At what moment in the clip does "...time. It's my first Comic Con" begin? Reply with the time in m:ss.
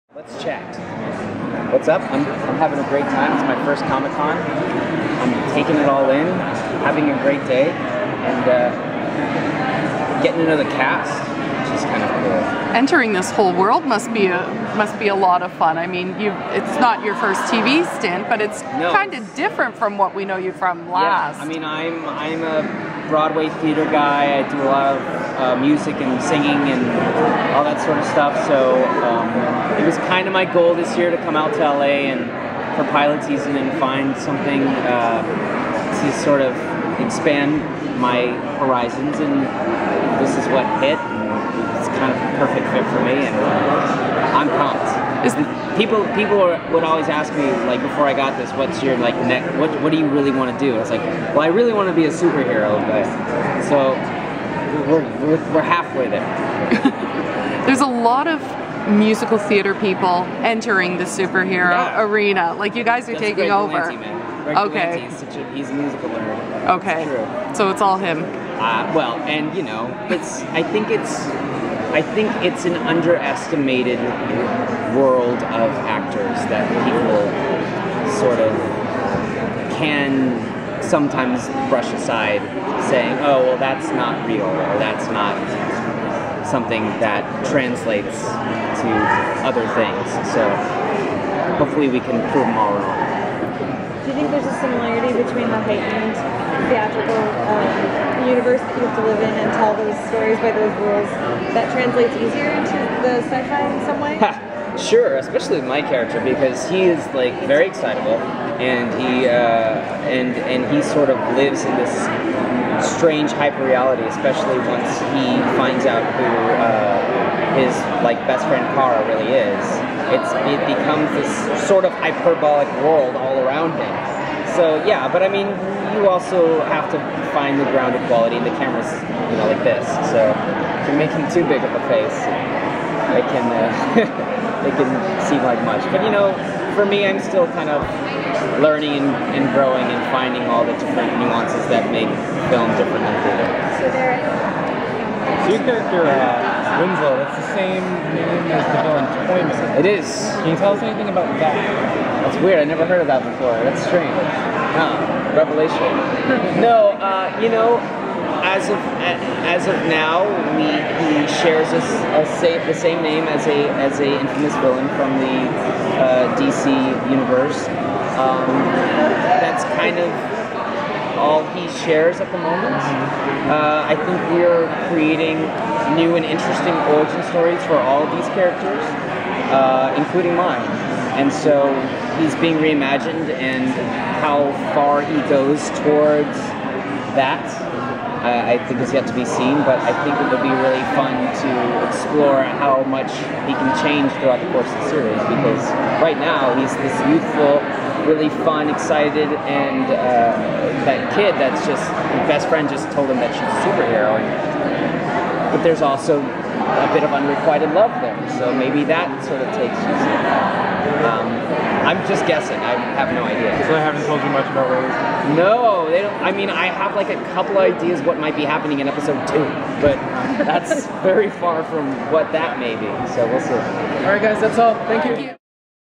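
0:03.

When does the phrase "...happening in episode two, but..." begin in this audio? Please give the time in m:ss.
3:38.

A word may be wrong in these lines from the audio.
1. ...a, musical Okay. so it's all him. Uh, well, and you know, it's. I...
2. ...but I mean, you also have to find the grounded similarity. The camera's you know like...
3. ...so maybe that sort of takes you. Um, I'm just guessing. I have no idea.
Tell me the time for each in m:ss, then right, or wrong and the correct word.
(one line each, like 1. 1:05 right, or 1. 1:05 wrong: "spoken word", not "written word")
1. 1:05 right
2. 2:05 wrong: "quality", not "similarity"
3. 3:28 right.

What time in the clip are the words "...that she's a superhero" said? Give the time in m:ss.
3:23.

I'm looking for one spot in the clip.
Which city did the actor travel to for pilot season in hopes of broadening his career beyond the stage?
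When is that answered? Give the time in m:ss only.
0:31.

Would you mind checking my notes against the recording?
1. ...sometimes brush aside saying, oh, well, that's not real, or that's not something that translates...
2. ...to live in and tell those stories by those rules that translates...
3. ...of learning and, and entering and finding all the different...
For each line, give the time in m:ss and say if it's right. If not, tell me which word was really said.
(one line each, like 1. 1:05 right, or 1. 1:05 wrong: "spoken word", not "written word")
1. 1:20 right
2. 1:38 right
3. 2:17 wrong: "growing", not "entering".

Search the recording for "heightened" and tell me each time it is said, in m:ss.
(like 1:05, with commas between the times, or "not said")
1:35.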